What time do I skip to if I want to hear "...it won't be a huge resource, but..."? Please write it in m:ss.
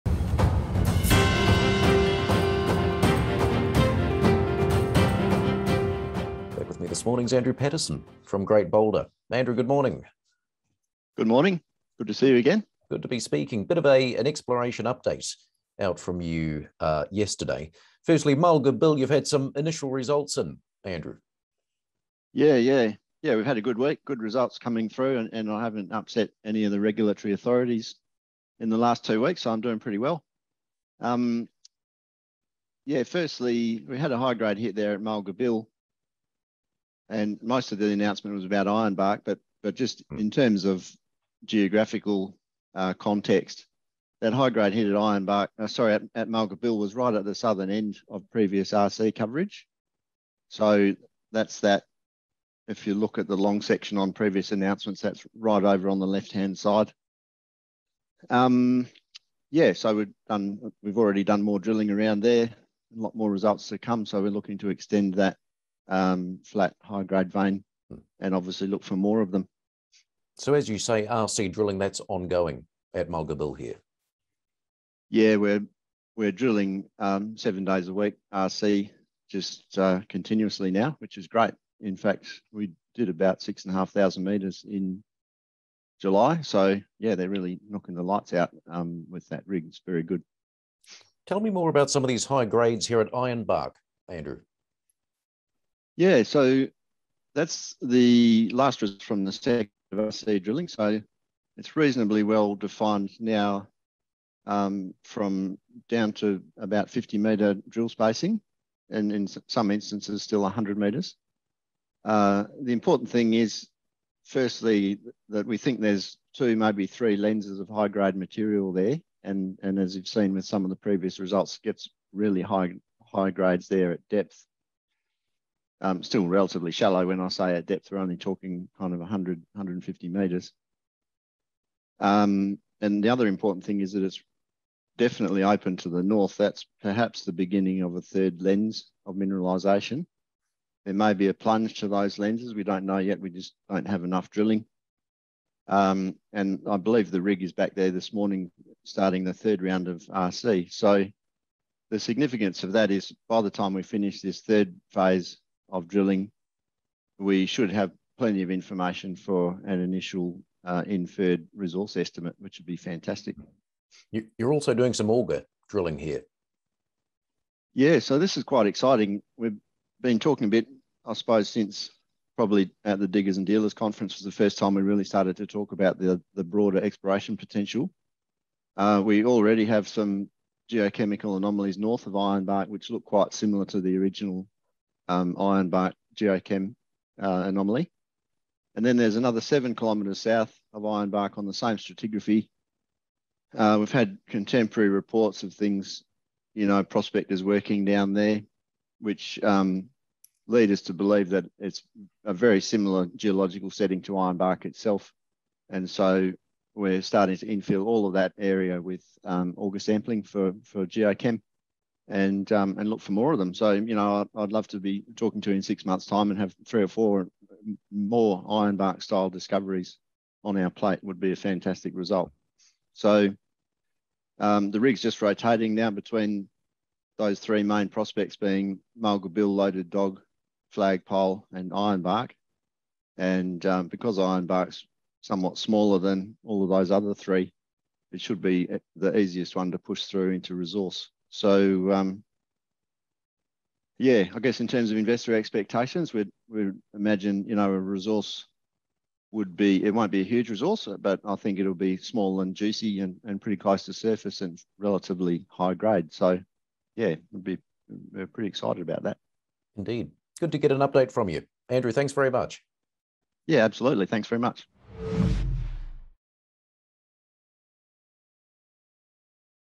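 4:09.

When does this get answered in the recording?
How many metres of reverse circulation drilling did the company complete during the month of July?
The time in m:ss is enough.
1:23.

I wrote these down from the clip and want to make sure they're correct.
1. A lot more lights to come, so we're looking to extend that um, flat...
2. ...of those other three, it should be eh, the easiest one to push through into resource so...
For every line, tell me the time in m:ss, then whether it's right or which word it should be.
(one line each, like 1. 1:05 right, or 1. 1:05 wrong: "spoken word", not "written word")
1. 1:02 wrong: "results", not "lights"
2. 3:56 right.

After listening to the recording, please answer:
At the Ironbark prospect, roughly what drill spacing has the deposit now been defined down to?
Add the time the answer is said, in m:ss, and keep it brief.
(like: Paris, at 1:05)
50 metres, at 1:46.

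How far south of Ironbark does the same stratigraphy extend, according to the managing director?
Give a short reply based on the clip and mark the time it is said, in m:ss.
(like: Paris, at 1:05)
7 kilometres, at 3:09.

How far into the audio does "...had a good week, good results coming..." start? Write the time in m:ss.
0:23.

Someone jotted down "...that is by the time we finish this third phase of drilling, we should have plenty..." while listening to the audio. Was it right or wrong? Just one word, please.
right.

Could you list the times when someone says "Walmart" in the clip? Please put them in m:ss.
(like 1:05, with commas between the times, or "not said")
not said.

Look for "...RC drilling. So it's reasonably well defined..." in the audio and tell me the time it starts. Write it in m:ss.
1:39.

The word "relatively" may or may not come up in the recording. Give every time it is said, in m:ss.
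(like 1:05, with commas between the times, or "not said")
2:06, 4:14.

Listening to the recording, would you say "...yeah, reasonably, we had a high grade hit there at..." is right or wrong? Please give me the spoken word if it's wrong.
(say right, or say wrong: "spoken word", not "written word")
wrong: "firstly", not "reasonably".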